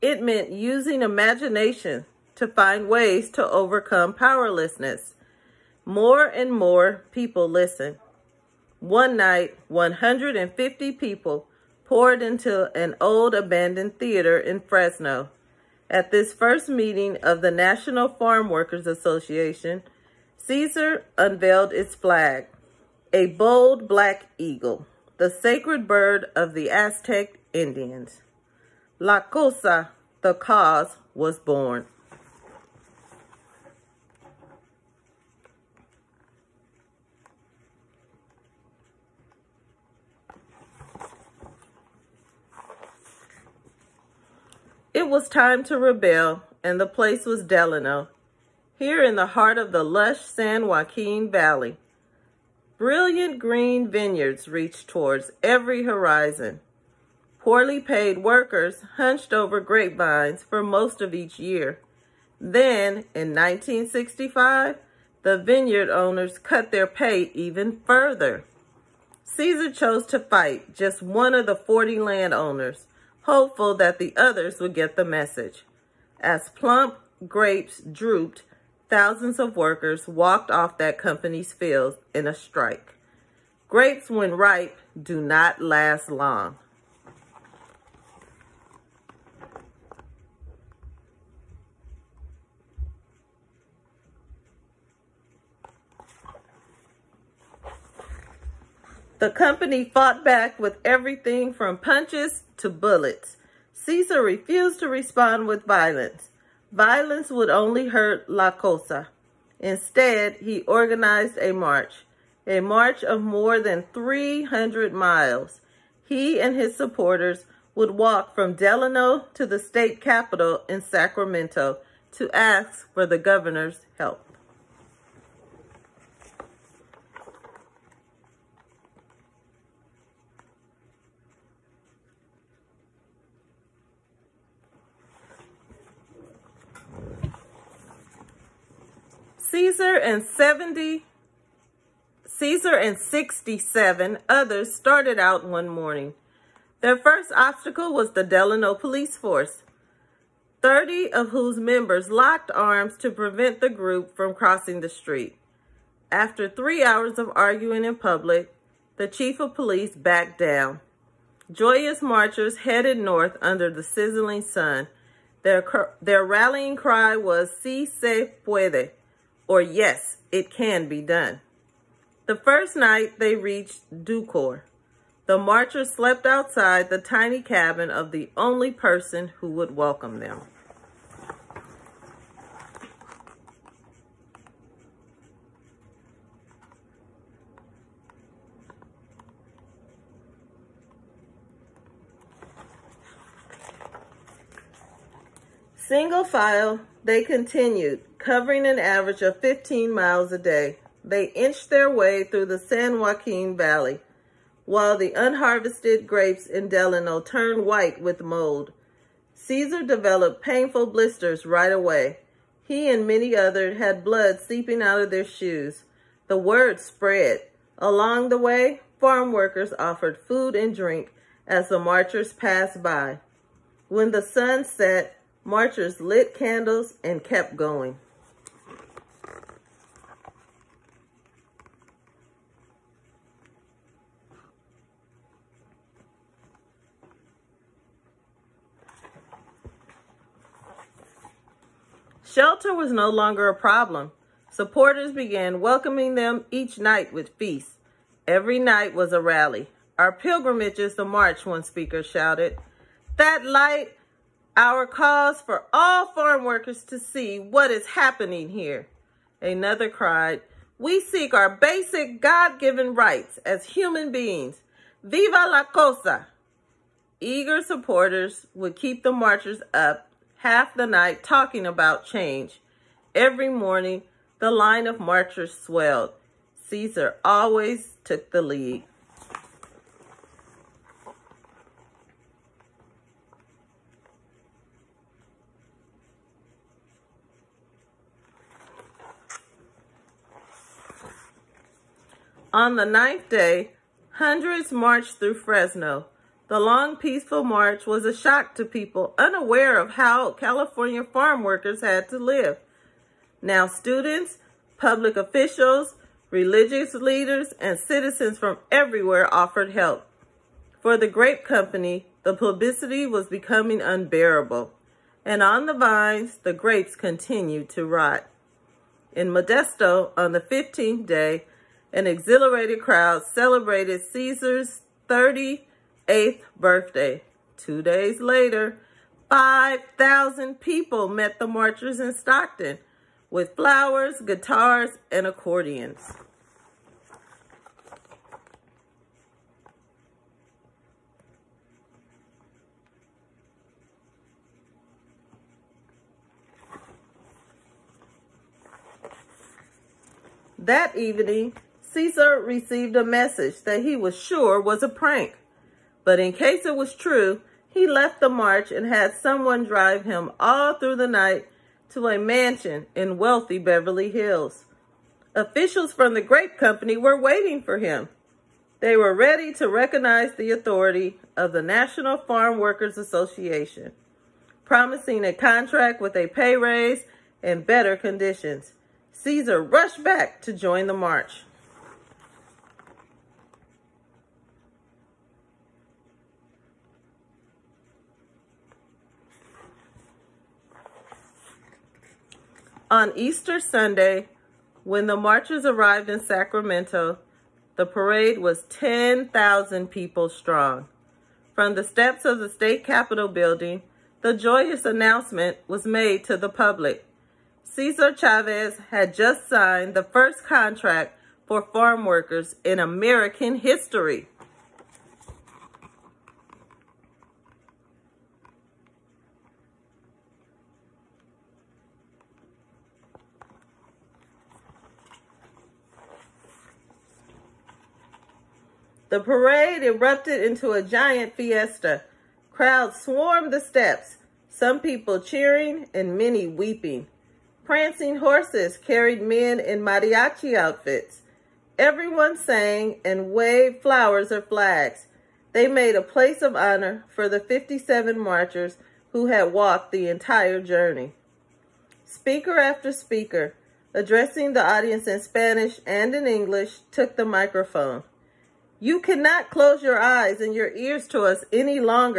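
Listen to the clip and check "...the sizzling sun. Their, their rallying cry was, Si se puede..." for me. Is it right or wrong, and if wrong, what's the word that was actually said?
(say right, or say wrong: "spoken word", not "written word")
right.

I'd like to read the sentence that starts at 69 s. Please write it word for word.
Cesar chose to fight just one of the 40 landowners, hopeful that the others would get the message.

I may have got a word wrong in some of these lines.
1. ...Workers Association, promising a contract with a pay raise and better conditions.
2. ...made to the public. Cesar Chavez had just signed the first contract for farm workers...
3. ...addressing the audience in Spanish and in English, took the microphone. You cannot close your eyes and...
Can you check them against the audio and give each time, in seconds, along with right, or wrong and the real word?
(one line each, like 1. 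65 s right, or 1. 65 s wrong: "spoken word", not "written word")
1. 372 s right
2. 405 s right
3. 453 s right.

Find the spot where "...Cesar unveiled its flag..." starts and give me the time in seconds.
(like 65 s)
20 s.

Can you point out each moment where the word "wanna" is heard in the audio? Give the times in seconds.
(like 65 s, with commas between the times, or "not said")
not said.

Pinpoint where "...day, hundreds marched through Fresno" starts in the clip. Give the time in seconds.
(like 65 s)
293 s.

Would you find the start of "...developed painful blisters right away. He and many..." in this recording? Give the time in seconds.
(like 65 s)
209 s.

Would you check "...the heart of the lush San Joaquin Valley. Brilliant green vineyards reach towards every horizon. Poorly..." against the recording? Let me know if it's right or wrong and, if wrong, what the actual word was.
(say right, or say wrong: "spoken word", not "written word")
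right.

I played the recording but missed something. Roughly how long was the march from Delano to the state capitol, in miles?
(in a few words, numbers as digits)
300 miles.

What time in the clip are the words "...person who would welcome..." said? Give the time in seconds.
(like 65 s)
178 s.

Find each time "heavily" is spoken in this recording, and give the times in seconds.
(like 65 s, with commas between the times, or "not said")
not said.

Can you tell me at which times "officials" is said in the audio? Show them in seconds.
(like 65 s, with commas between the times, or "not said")
305 s, 365 s.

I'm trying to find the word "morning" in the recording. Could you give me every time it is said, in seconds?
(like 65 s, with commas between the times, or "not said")
145 s, 273 s.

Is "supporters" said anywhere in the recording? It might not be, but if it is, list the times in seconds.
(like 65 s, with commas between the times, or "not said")
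116 s, 244 s, 267 s.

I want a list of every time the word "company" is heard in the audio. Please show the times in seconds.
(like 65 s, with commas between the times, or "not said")
80 s, 99 s, 311 s, 366 s.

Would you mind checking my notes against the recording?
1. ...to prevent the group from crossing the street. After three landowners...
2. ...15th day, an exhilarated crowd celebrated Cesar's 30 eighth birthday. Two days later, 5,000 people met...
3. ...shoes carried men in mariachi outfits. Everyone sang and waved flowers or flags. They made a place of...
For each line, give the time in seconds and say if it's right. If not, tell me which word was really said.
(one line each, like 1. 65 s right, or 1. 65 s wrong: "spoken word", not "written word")
1. 152 s wrong: "hours", not "landowners"
2. 320 s right
3. 438 s wrong: "horses", not "shoes".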